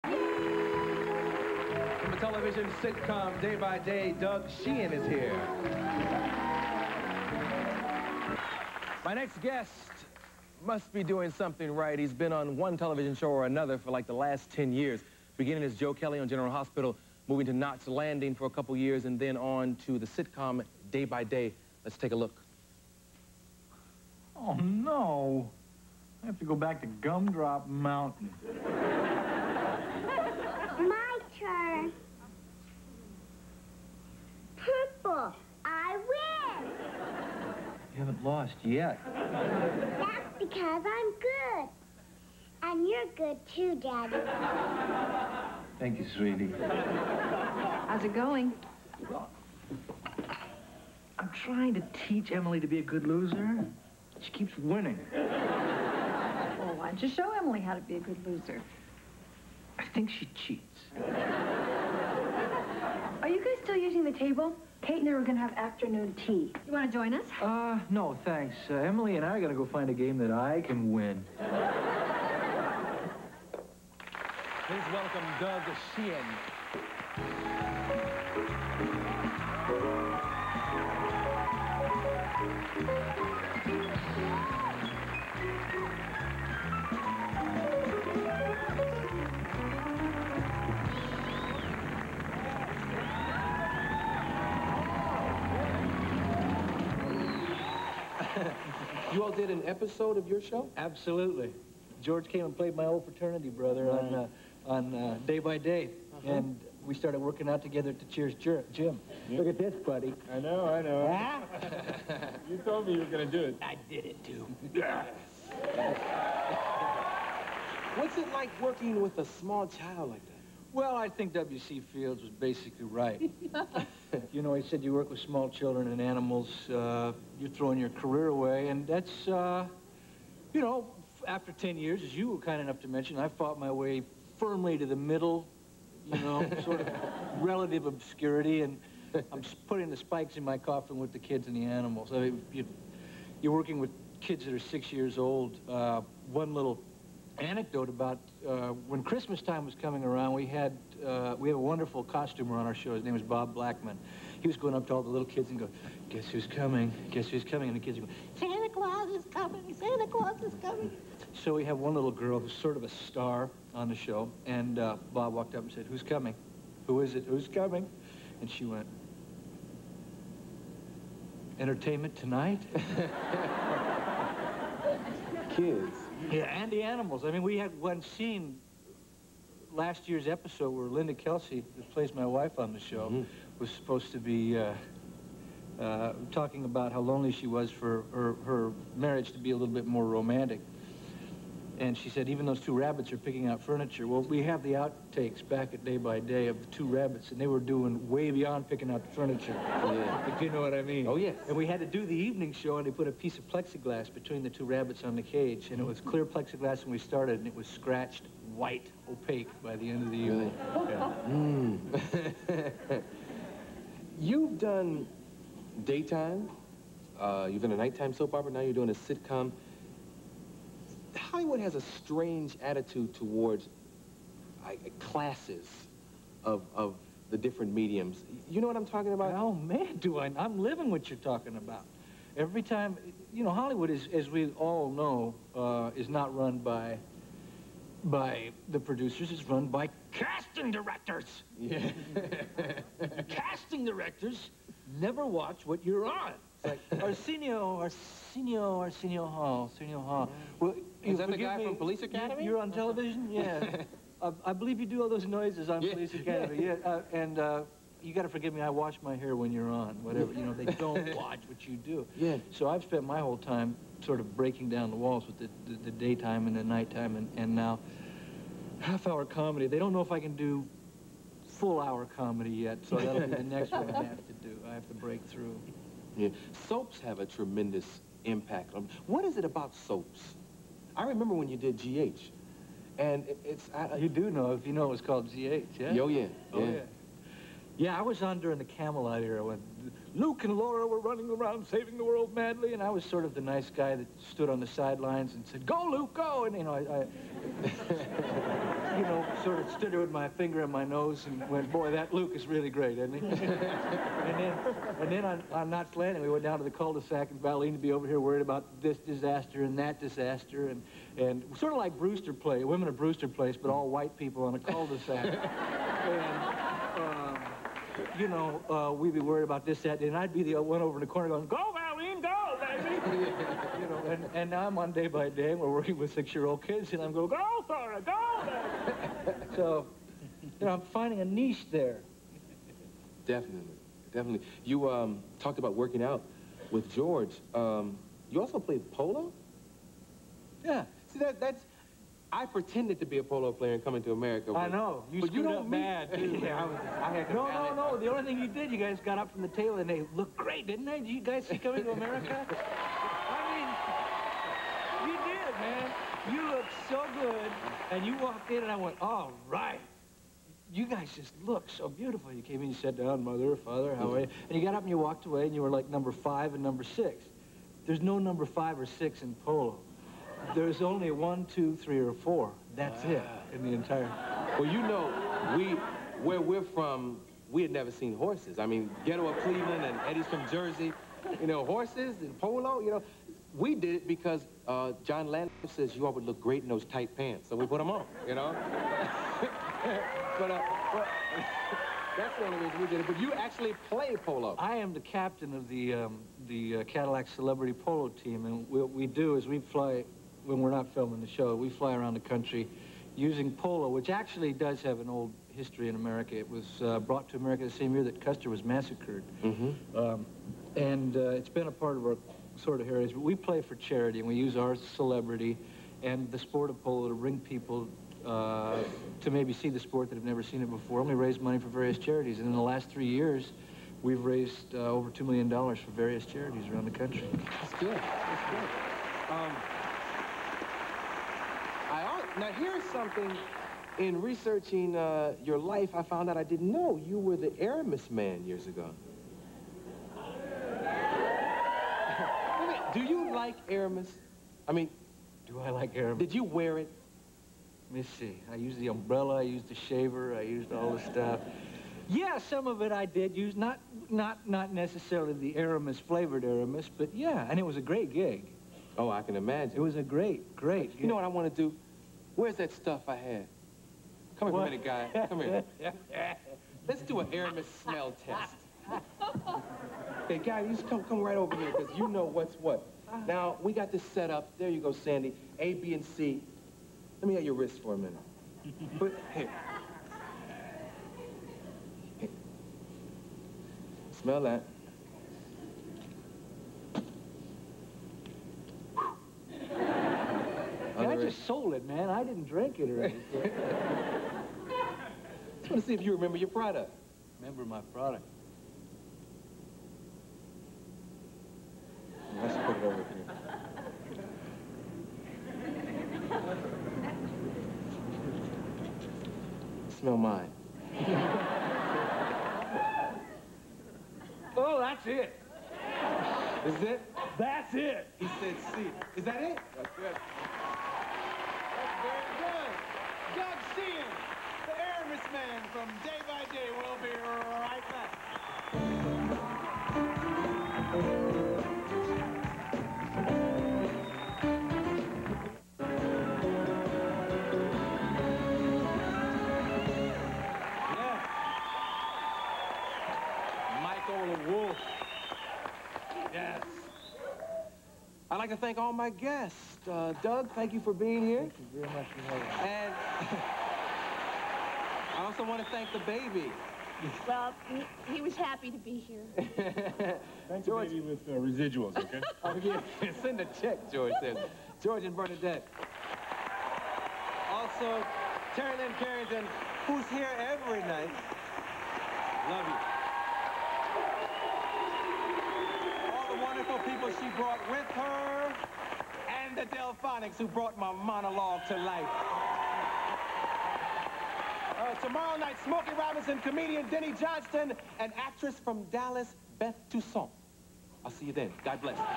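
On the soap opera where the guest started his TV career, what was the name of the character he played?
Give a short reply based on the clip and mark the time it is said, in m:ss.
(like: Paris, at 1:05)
Joe Kelly, at 0:15.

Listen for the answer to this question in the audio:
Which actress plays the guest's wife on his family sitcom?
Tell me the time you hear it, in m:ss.
3:00.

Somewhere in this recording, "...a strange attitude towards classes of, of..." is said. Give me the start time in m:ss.
3:41.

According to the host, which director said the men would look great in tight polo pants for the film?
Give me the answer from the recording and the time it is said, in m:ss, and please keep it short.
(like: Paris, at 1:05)
John Landis, at 6:25.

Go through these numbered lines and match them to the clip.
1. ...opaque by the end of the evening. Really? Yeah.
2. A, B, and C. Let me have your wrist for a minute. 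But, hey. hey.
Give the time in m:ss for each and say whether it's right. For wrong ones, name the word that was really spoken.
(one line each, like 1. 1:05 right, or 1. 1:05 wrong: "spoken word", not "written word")
1. 3:29 right
2. 7:55 right.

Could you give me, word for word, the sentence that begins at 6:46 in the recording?
It was uh, brought to America the same year that Custer was massacred.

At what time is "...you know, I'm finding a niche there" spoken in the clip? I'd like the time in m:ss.
5:30.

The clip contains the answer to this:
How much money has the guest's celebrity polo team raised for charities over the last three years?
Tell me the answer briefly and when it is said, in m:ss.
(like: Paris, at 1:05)
Over $2 million, at 7:04.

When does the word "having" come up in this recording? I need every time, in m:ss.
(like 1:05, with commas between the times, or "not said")
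9:12.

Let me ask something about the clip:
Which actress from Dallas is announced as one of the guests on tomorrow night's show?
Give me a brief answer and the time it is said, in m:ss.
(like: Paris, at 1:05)
Beth Toussaint, at 9:49.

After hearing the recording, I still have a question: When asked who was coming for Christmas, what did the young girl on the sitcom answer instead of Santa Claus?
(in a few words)
Entertainment Tonight.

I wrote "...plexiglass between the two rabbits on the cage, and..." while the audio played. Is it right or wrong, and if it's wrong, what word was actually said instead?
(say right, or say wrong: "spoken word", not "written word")
right.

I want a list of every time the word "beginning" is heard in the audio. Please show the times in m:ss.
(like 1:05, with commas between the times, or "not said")
0:15.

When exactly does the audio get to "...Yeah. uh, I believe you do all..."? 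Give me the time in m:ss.
4:13.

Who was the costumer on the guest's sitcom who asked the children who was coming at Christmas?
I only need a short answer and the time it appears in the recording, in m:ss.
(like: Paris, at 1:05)
Bob Blackman, at 2:33.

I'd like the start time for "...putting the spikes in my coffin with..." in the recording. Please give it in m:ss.
2:19.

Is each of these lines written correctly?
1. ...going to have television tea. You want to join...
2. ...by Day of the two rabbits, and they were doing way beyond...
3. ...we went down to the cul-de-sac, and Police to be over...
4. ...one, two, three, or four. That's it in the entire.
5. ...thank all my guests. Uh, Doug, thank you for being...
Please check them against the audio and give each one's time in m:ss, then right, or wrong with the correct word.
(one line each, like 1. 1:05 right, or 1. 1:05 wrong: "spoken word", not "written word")
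1. 1:05 wrong: "afternoon", not "television"
2. 3:15 right
3. 5:06 wrong: "Valene", not "Police"
4. 6:11 right
5. 9:08 right.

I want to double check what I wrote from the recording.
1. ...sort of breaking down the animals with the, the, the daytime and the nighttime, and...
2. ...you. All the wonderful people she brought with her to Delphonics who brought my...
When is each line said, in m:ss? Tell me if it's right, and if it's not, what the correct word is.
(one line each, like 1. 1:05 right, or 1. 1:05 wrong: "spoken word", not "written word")
1. 4:24 wrong: "walls", not "animals"
2. 9:35 right.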